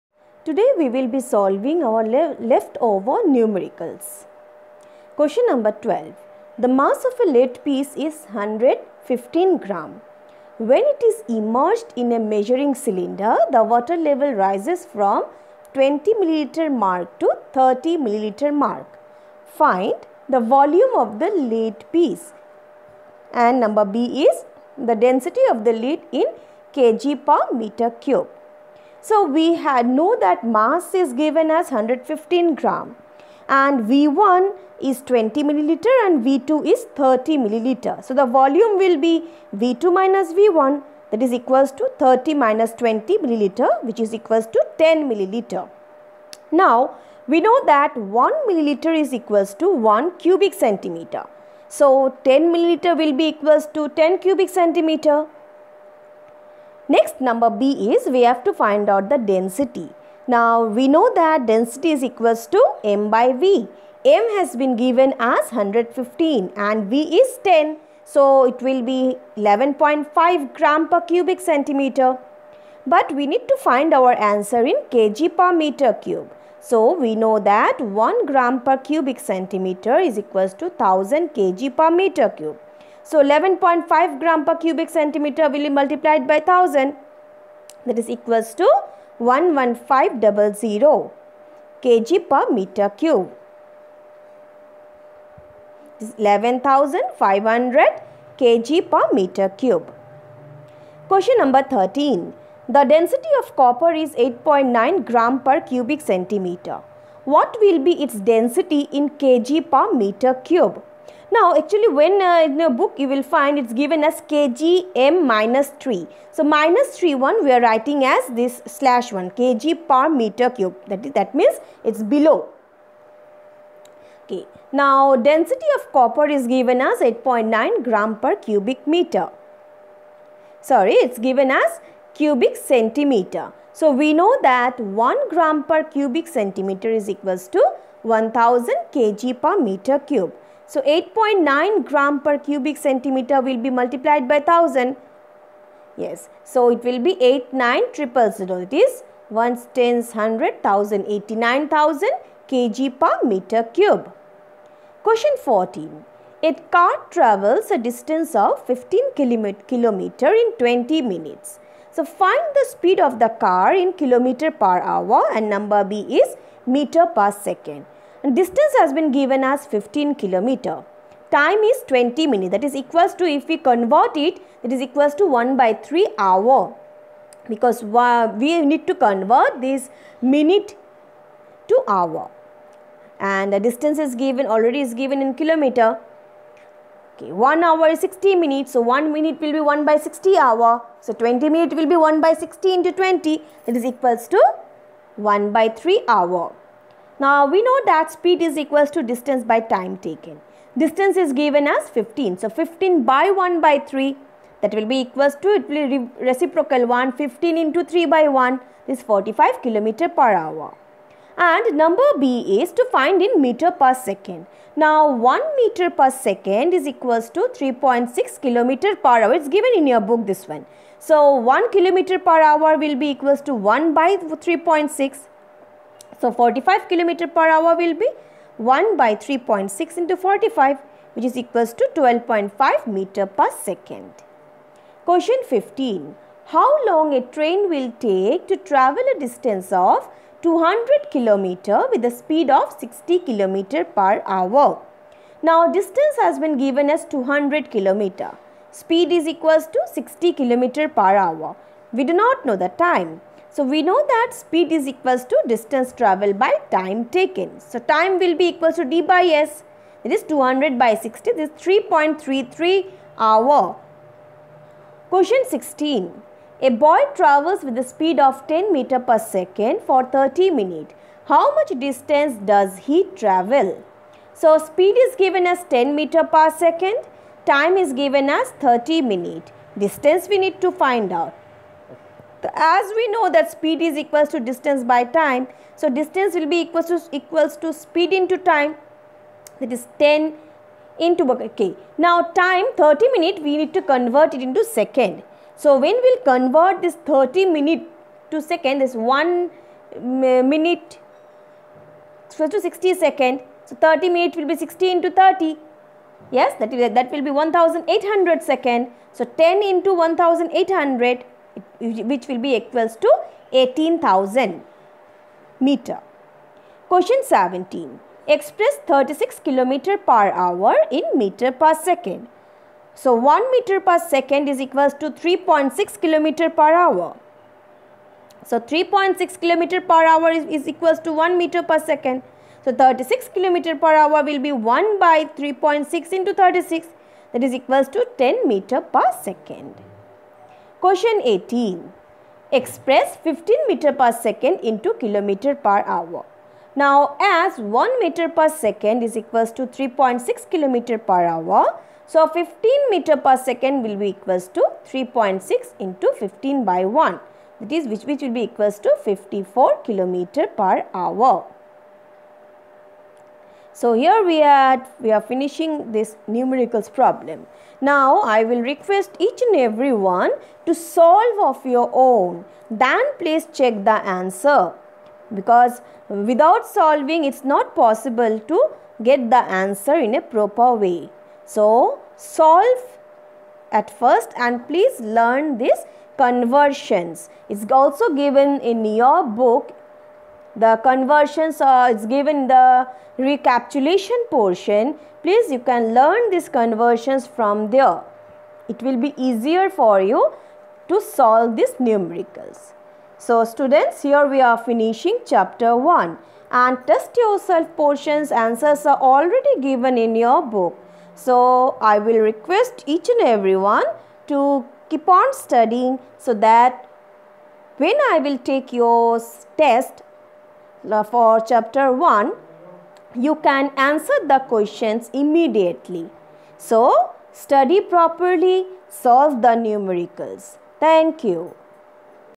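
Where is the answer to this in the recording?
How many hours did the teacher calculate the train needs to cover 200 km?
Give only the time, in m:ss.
4:21.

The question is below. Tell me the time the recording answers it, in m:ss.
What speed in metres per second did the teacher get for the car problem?
3:51.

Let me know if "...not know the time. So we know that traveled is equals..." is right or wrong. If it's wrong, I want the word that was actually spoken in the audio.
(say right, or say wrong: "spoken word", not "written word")
wrong: "speed", not "traveled".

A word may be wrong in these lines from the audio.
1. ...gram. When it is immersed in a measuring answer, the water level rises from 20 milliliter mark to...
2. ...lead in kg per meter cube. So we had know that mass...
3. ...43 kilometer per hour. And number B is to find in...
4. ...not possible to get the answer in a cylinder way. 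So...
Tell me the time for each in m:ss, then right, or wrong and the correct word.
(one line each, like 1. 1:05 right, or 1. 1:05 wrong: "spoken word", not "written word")
1. 0:09 wrong: "cylinder", not "answer"
2. 0:25 right
3. 3:29 wrong: "45", not "43"
4. 6:17 wrong: "proper", not "cylinder".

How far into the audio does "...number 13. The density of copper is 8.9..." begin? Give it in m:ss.
1:41.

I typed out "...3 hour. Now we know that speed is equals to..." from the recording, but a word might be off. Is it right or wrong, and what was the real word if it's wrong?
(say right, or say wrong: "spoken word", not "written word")
right.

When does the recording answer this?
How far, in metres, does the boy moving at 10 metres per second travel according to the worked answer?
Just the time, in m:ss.
5:13.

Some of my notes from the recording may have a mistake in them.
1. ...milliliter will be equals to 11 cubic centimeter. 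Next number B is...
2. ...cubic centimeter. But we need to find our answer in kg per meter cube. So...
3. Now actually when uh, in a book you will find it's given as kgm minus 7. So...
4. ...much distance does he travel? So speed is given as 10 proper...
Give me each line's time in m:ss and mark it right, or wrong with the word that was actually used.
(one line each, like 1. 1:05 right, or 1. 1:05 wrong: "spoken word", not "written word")
1. 0:52 wrong: "10", not "11"
2. 1:11 right
3. 1:51 wrong: "3", not "7"
4. 4:31 wrong: "meter", not "proper".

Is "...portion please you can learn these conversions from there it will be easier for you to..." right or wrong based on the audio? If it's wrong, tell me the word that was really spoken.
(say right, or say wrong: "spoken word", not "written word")
right.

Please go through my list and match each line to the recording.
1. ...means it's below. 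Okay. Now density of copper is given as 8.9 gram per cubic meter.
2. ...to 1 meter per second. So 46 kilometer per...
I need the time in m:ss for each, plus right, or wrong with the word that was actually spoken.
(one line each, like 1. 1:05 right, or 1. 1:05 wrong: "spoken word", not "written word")
1. 2:01 right
2. 5:30 wrong: "36", not "46".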